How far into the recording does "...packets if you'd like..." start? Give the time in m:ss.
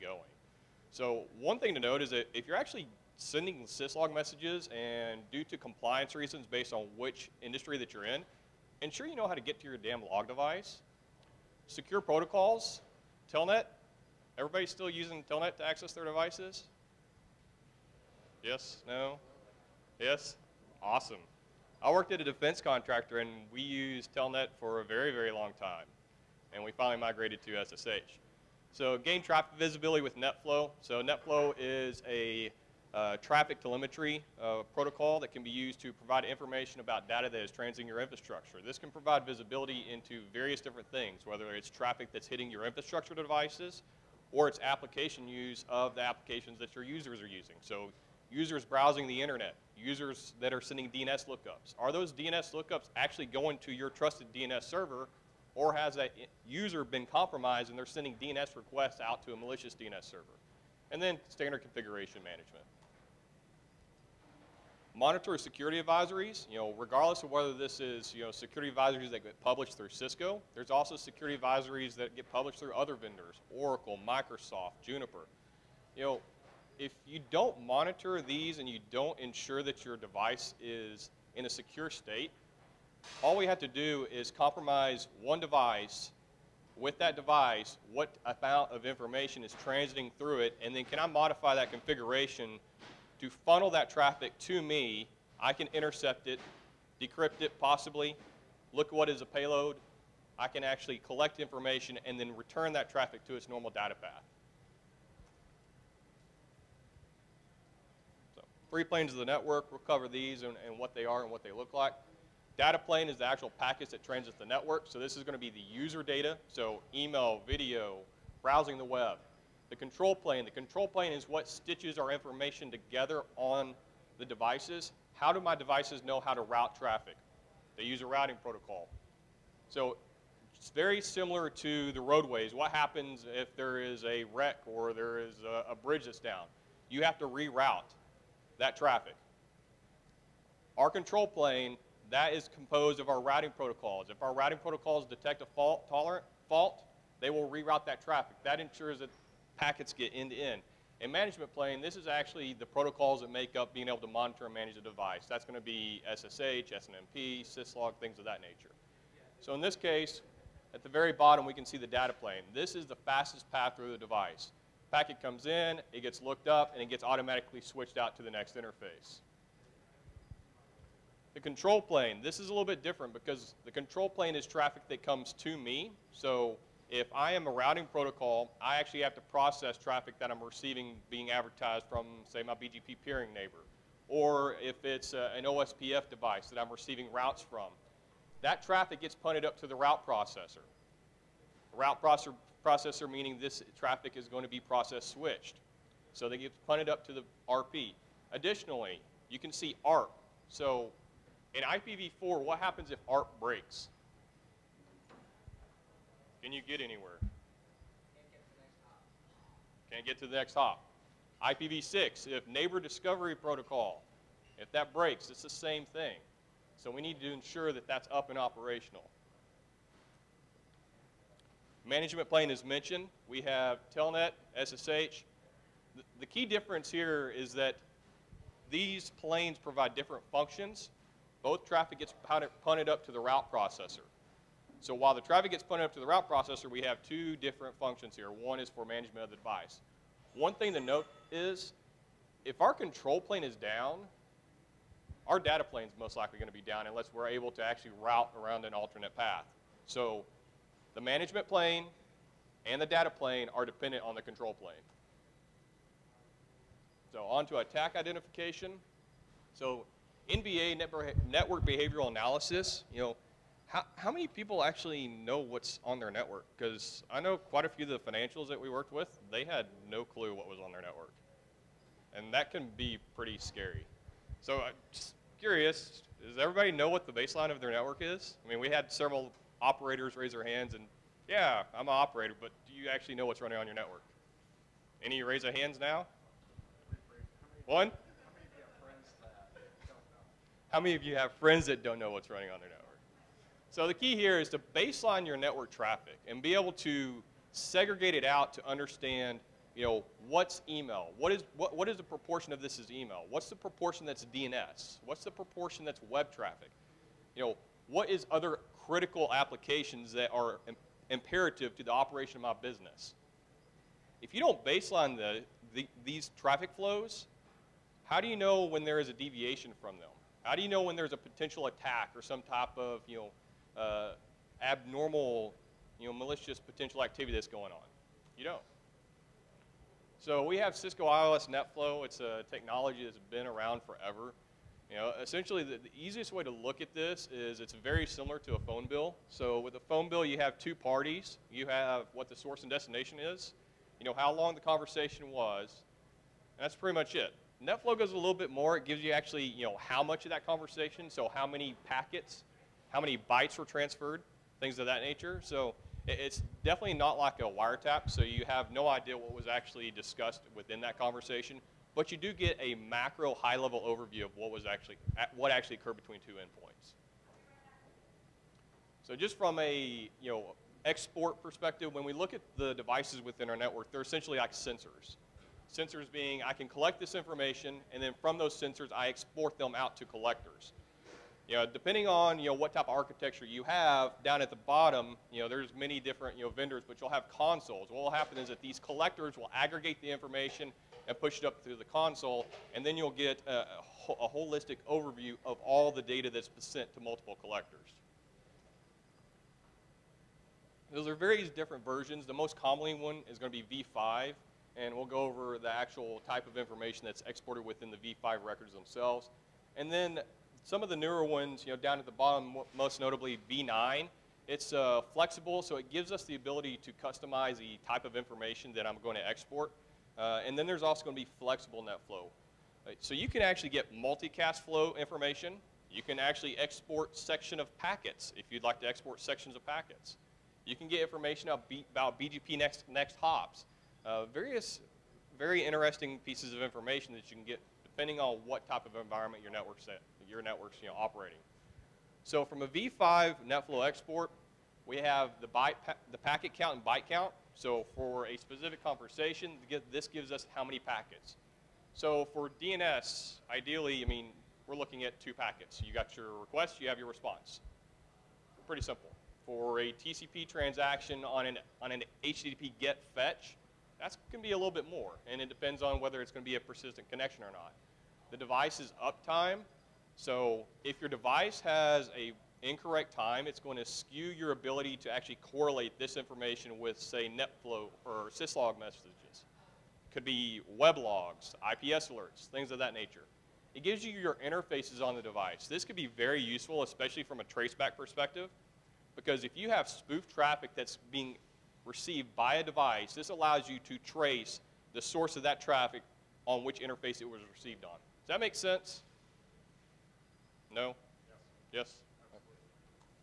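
7:07.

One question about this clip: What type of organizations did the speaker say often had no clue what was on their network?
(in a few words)
financials.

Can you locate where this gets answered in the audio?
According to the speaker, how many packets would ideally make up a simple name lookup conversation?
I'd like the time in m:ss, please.
7:35.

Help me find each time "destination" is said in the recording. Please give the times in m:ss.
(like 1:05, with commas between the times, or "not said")
5:42.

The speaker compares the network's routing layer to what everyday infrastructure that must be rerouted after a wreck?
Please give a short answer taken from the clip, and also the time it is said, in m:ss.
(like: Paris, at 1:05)
roadways, at 2:12.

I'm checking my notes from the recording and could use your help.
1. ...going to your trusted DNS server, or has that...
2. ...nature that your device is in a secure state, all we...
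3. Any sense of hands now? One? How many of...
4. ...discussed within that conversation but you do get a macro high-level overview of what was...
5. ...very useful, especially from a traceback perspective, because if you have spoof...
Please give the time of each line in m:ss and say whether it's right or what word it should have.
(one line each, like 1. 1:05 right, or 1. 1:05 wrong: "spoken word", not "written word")
1. 0:53 right
2. 1:19 wrong: "ensure", not "nature"
3. 4:45 wrong: "raise", not "sense"
4. 5:59 right
5. 8:06 right.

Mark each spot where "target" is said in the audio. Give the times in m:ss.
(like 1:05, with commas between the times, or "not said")
not said.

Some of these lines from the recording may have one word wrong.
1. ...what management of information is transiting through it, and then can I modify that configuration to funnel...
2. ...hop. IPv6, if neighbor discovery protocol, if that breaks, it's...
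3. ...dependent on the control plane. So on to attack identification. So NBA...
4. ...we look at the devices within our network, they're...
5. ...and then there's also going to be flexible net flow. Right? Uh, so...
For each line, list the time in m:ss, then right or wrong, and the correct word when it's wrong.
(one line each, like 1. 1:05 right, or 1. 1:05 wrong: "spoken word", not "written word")
1. 1:27 wrong: "amount", not "management"
2. 3:30 right
3. 4:13 right
4. 6:12 right
5. 7:00 right.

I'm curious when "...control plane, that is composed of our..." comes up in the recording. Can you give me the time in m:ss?
2:20.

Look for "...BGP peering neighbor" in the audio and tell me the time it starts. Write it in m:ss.
3:02.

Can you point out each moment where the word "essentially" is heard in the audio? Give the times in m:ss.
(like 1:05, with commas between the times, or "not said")
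5:35, 6:14.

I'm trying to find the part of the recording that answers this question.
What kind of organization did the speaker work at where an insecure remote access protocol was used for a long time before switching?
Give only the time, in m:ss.
0:22.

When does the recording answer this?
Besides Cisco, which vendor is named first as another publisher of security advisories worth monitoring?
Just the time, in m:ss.
1:13.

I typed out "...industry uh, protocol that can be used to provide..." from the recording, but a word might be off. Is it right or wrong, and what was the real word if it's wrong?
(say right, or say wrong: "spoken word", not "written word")
wrong: "telemetry", not "industry".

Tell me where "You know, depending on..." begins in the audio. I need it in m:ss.
6:21.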